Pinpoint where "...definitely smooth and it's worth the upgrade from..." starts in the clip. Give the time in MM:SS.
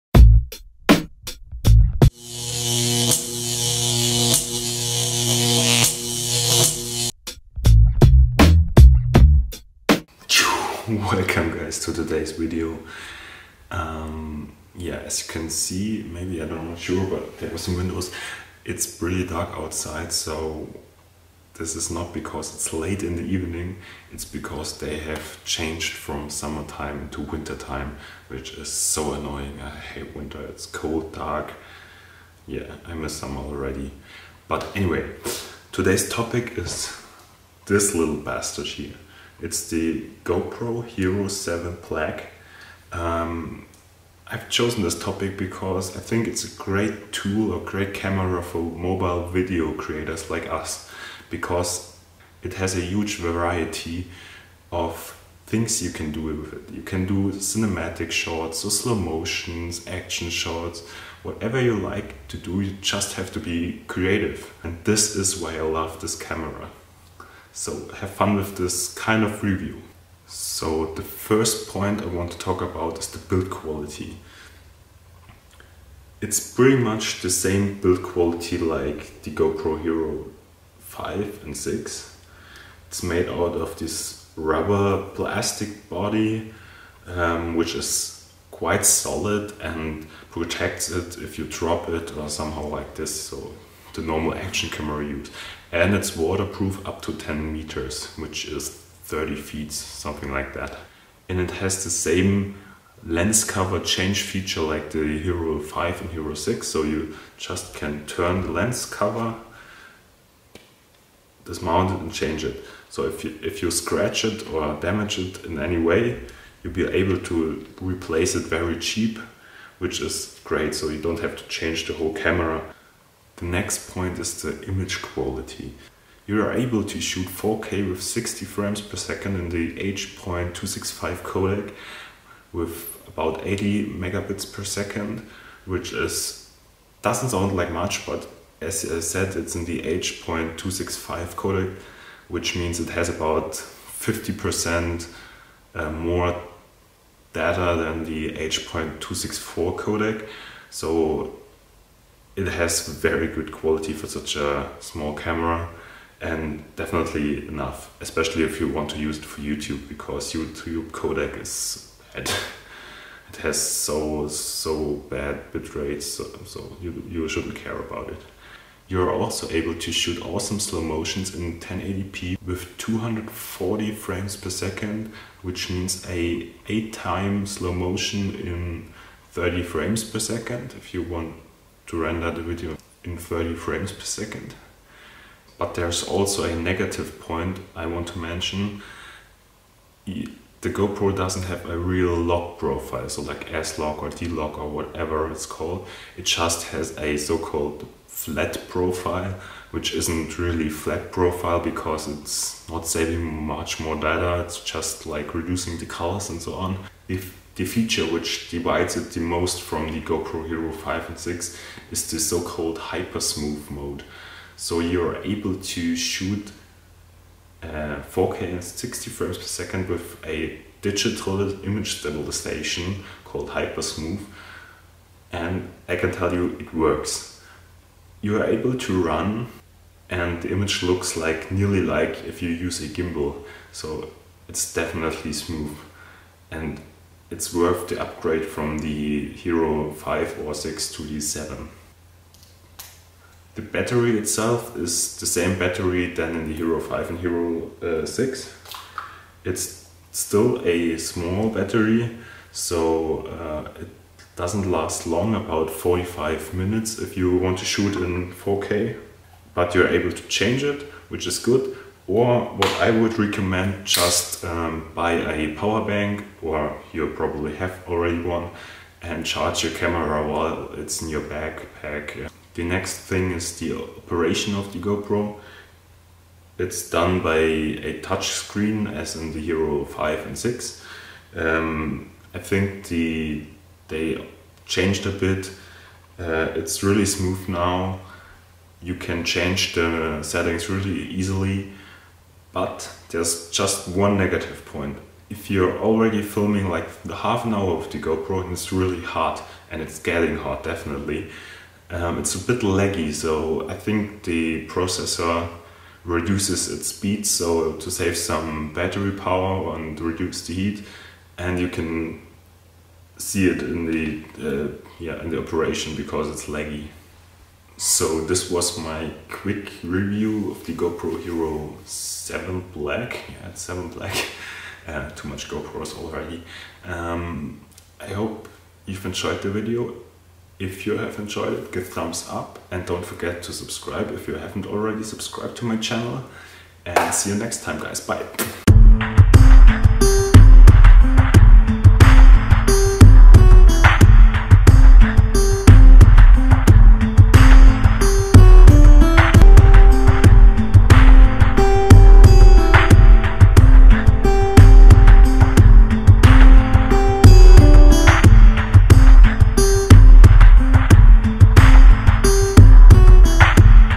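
03:54.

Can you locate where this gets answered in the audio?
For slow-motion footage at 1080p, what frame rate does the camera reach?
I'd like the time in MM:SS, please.
02:52.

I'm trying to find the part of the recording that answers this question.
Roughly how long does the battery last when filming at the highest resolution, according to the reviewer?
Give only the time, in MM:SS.
04:15.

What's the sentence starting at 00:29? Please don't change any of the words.
I hate winter, it's cold, dark.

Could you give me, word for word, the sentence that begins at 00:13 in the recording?
Um, yeah, as you can see, maybe I don't know sure, but there are some windows.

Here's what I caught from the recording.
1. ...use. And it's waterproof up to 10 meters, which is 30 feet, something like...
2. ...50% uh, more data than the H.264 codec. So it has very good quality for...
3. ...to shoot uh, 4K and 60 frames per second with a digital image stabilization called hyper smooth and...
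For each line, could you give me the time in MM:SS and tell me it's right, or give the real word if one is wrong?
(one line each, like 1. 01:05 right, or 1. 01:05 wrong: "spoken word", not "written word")
1. 01:35 right
2. 02:23 right
3. 03:35 right.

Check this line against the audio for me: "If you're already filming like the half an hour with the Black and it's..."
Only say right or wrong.
wrong.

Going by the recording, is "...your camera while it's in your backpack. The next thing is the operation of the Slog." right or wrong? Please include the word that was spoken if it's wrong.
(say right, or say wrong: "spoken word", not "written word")
wrong: "GoPro", not "Slog".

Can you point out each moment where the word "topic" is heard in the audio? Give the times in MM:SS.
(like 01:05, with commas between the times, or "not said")
00:36, 00:44.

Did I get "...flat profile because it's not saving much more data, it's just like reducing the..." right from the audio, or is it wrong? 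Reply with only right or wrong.
right.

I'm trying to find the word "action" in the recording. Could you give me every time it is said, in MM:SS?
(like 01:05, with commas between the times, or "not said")
00:59, 01:34.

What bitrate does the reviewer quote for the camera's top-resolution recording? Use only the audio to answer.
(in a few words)
80 megabits per second.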